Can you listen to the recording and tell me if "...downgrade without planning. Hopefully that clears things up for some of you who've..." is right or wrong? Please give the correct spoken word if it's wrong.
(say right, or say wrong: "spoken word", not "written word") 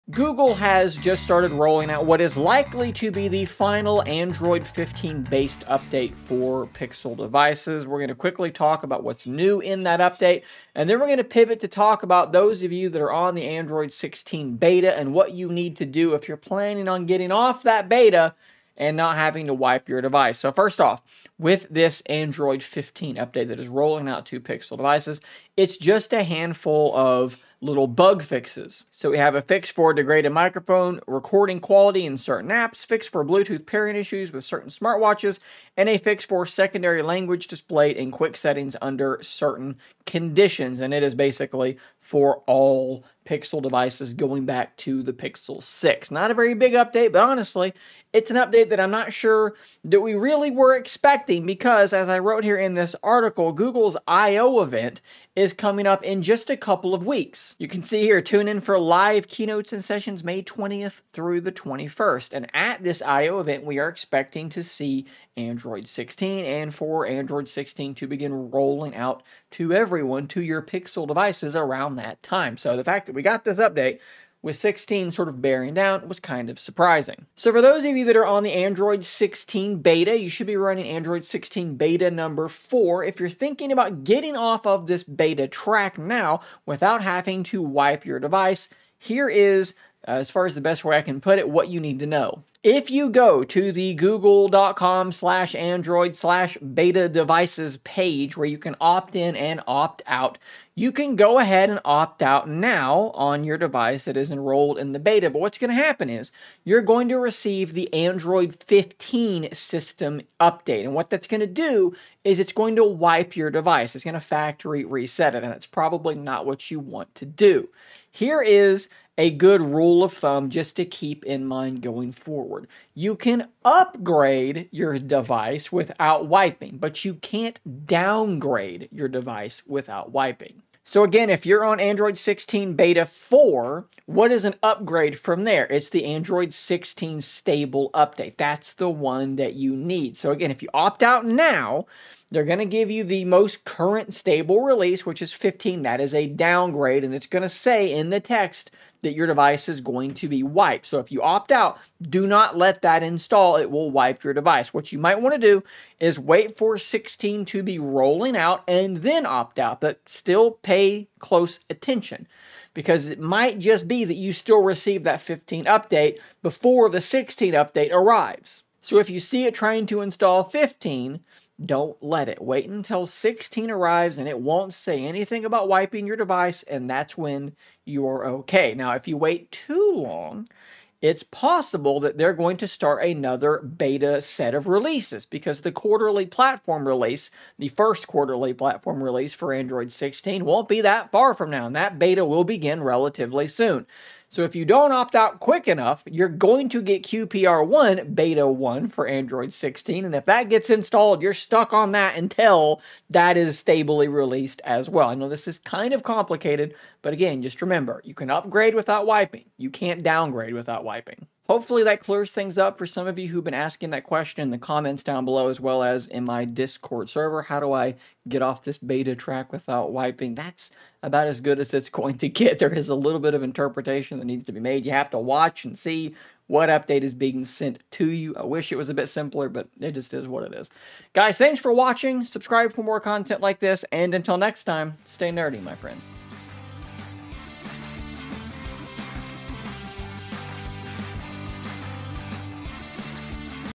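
wrong: "wiping", not "planning".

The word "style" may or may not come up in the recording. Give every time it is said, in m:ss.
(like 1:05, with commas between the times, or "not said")
not said.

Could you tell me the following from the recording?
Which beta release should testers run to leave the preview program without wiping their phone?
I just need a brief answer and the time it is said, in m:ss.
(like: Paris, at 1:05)
4, at 1:20.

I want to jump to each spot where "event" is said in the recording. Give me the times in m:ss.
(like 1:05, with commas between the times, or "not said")
0:54, 1:03.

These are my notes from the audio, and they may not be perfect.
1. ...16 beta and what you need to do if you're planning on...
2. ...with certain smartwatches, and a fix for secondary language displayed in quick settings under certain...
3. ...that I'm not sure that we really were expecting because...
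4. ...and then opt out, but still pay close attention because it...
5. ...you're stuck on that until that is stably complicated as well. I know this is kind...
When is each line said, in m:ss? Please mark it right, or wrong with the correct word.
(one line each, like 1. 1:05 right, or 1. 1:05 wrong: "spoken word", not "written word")
1. 0:13 right
2. 0:34 right
3. 0:48 right
4. 2:38 right
5. 3:21 wrong: "released", not "complicated".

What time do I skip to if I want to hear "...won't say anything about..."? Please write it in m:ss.
2:54.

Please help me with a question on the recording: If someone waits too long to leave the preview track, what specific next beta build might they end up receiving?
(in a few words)
QPR1 beta 1.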